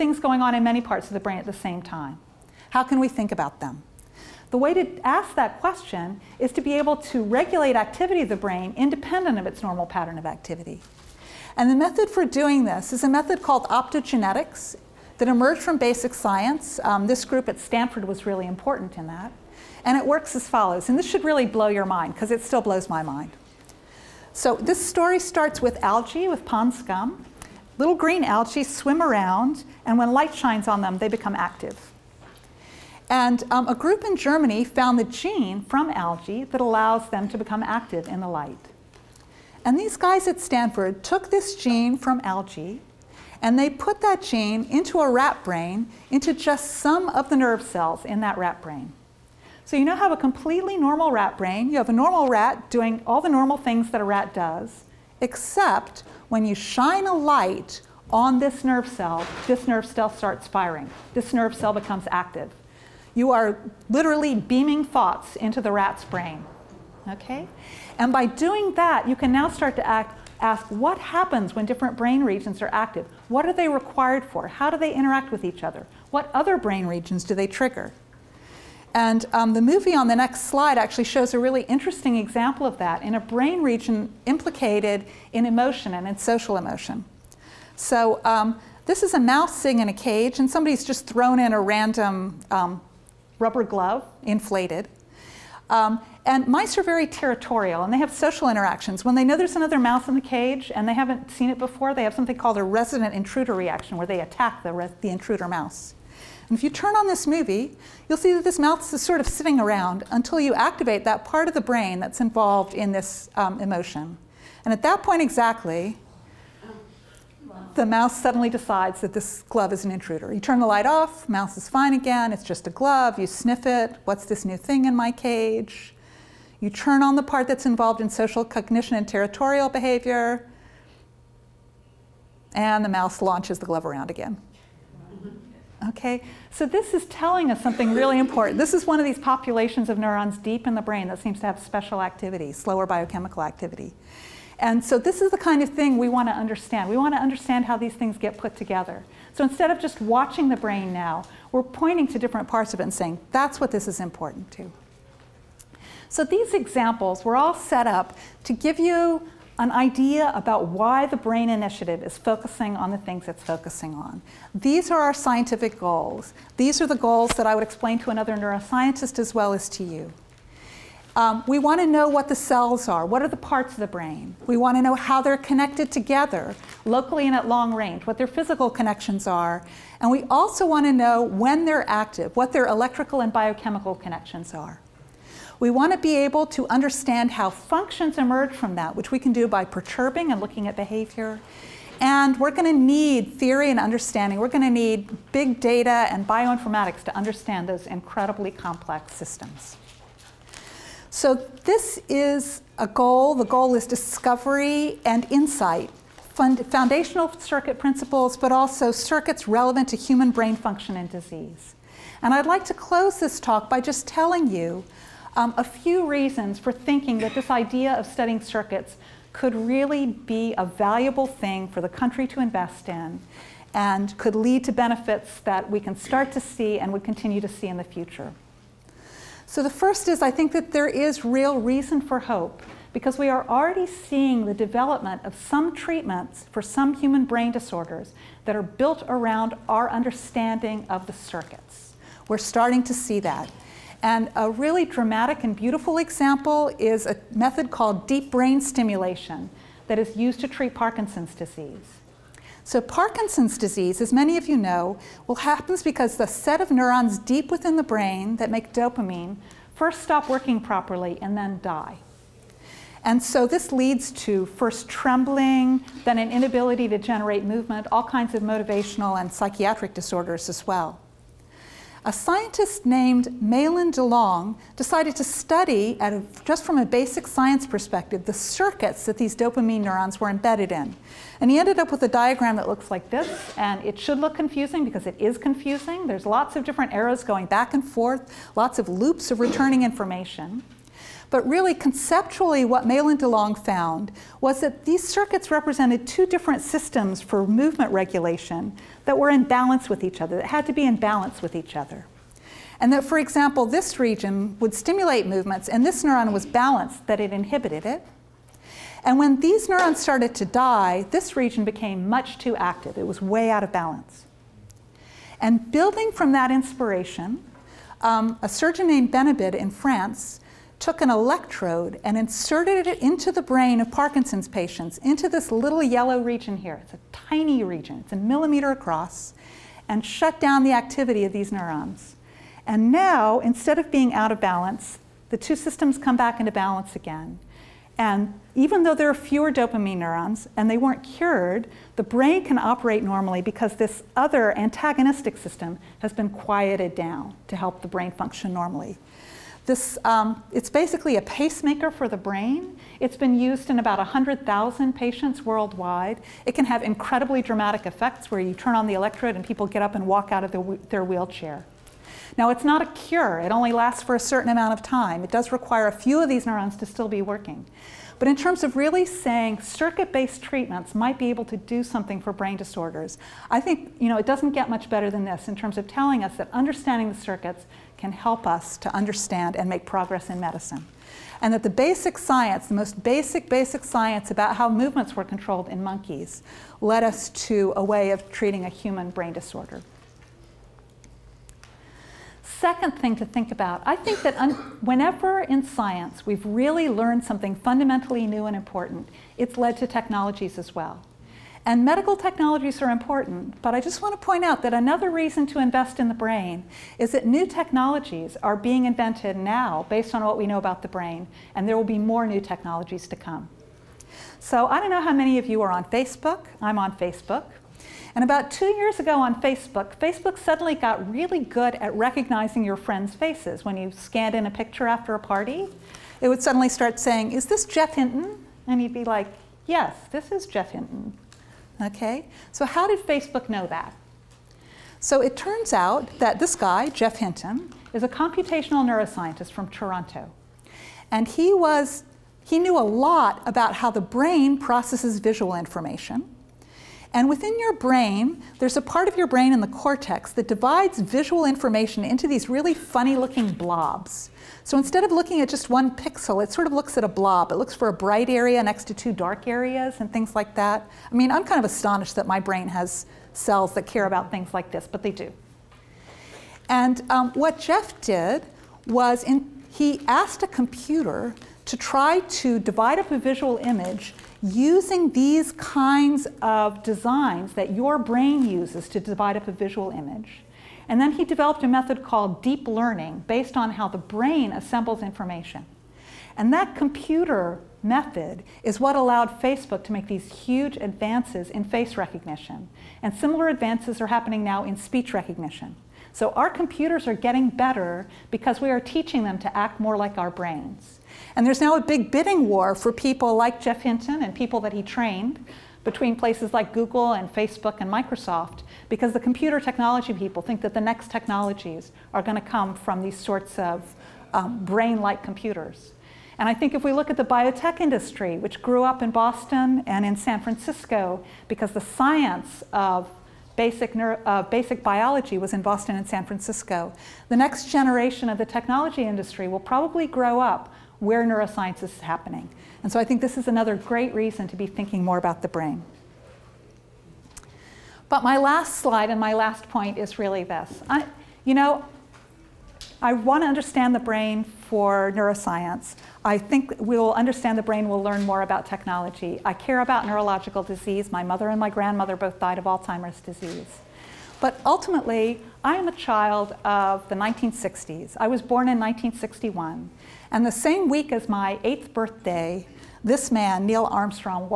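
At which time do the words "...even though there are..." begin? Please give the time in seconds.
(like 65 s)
338 s.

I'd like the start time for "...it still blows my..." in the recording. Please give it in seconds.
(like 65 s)
22 s.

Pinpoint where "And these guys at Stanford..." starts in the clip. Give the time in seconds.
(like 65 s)
39 s.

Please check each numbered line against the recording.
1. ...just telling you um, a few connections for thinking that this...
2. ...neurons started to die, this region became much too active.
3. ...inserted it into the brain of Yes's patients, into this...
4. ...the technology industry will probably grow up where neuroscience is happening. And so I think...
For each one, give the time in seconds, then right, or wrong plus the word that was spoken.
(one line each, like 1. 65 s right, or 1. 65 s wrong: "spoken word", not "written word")
1. 213 s wrong: "reasons", not "connections"
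2. 309 s right
3. 322 s wrong: "Parkinson", not "Yes"
4. 528 s right.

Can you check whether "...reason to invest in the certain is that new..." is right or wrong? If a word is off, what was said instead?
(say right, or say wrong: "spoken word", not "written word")
wrong: "brain", not "certain".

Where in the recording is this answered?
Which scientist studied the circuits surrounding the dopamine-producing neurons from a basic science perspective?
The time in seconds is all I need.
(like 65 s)
273 s.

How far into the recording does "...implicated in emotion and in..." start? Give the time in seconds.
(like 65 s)
84 s.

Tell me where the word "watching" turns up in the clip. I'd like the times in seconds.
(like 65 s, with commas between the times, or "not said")
149 s.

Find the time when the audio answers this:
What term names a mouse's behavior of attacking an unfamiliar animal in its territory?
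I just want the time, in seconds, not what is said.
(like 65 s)
102 s.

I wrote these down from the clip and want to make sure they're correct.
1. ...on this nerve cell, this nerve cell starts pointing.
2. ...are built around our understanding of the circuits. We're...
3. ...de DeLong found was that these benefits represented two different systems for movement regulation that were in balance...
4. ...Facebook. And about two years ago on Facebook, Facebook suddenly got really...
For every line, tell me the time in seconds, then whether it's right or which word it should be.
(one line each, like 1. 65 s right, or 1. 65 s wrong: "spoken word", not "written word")
1. 58 s wrong: "firing", not "pointing"
2. 238 s right
3. 293 s wrong: "circuits", not "benefits"
4. 416 s right.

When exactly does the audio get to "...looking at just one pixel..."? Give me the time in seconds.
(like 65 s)
455 s.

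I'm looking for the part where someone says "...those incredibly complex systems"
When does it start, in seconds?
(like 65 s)
197 s.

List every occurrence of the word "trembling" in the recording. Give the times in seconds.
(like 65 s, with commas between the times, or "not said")
264 s.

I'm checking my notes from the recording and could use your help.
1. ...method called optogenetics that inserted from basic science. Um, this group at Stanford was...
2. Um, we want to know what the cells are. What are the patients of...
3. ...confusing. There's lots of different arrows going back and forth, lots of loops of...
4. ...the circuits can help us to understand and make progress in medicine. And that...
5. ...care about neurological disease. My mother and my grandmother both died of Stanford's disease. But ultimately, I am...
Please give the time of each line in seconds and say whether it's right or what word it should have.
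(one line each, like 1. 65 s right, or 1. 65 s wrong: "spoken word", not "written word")
1. 13 s wrong: "emerged", not "inserted"
2. 171 s wrong: "parts", not "patients"
3. 285 s right
4. 377 s right
5. 549 s wrong: "Alzheimer", not "Stanford".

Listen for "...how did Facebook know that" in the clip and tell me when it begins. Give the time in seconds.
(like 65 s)
432 s.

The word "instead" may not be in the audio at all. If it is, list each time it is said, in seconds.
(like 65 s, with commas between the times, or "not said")
149 s, 333 s, 454 s.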